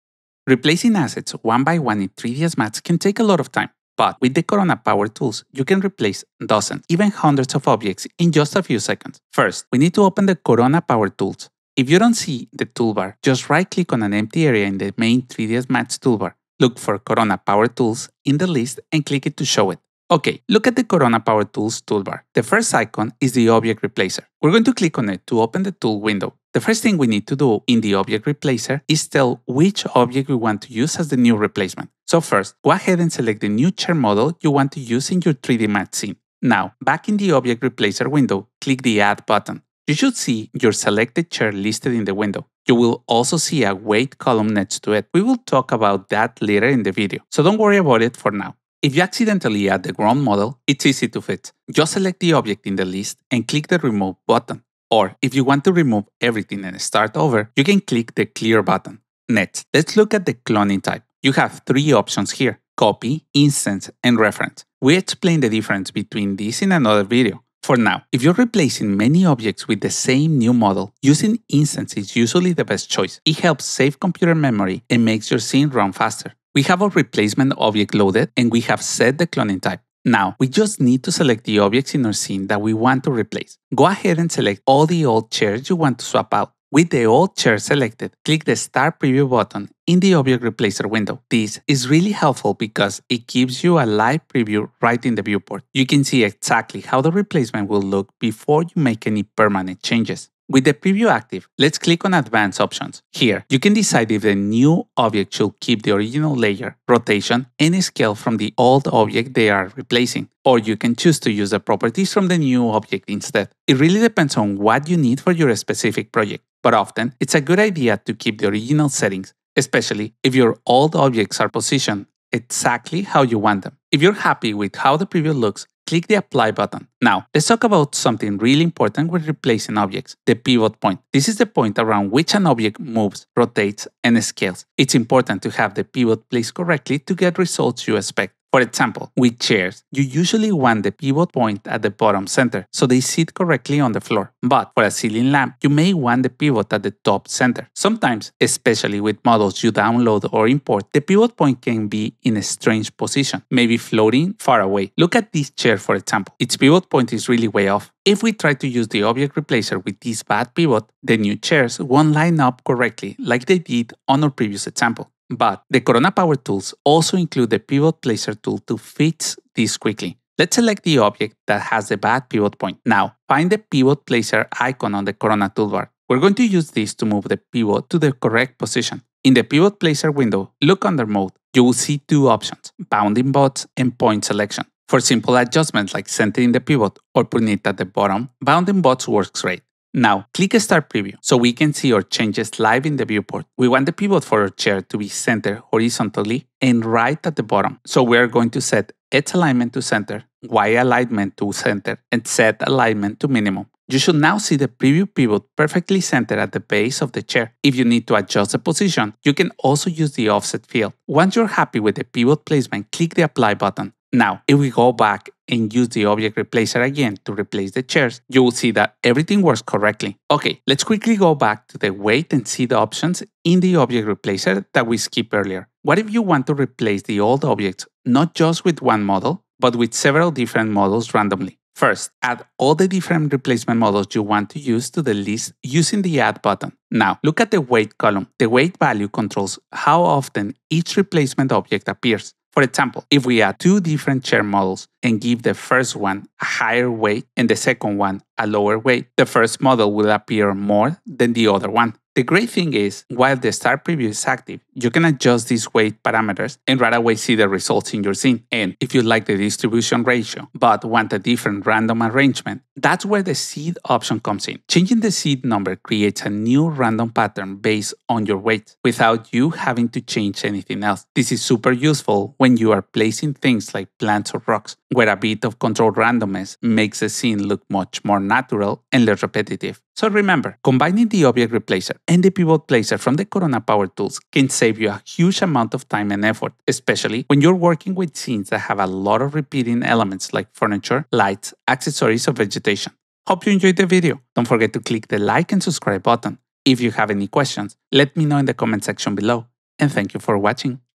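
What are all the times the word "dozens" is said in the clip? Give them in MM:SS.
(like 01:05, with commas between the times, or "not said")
00:06.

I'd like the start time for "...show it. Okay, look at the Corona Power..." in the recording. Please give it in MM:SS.
00:19.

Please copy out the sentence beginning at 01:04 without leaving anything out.
We explain the difference between these in another video.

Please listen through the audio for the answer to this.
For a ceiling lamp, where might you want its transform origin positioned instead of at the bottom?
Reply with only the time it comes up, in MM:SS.
02:26.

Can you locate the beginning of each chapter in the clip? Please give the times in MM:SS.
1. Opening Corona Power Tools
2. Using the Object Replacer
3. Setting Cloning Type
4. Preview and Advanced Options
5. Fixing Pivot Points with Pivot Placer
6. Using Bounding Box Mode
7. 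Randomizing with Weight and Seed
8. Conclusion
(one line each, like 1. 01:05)
1. 00:10
2. 00:21
3. 01:00
4. 01:20
5. 02:08
6. 03:02
7. 03:42
8. 04:39.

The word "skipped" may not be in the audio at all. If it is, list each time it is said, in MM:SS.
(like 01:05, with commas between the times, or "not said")
03:44.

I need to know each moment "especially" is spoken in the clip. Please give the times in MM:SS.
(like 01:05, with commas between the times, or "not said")
01:59, 02:28, 04:46.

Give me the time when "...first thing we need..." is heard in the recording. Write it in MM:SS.
00:26.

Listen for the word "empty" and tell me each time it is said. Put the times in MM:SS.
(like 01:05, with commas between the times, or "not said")
00:14.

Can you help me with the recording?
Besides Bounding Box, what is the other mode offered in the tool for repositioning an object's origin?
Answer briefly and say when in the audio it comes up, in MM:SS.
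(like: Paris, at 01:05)
Point Selection, at 03:03.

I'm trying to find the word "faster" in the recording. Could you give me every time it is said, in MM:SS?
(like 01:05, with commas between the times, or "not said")
01:15.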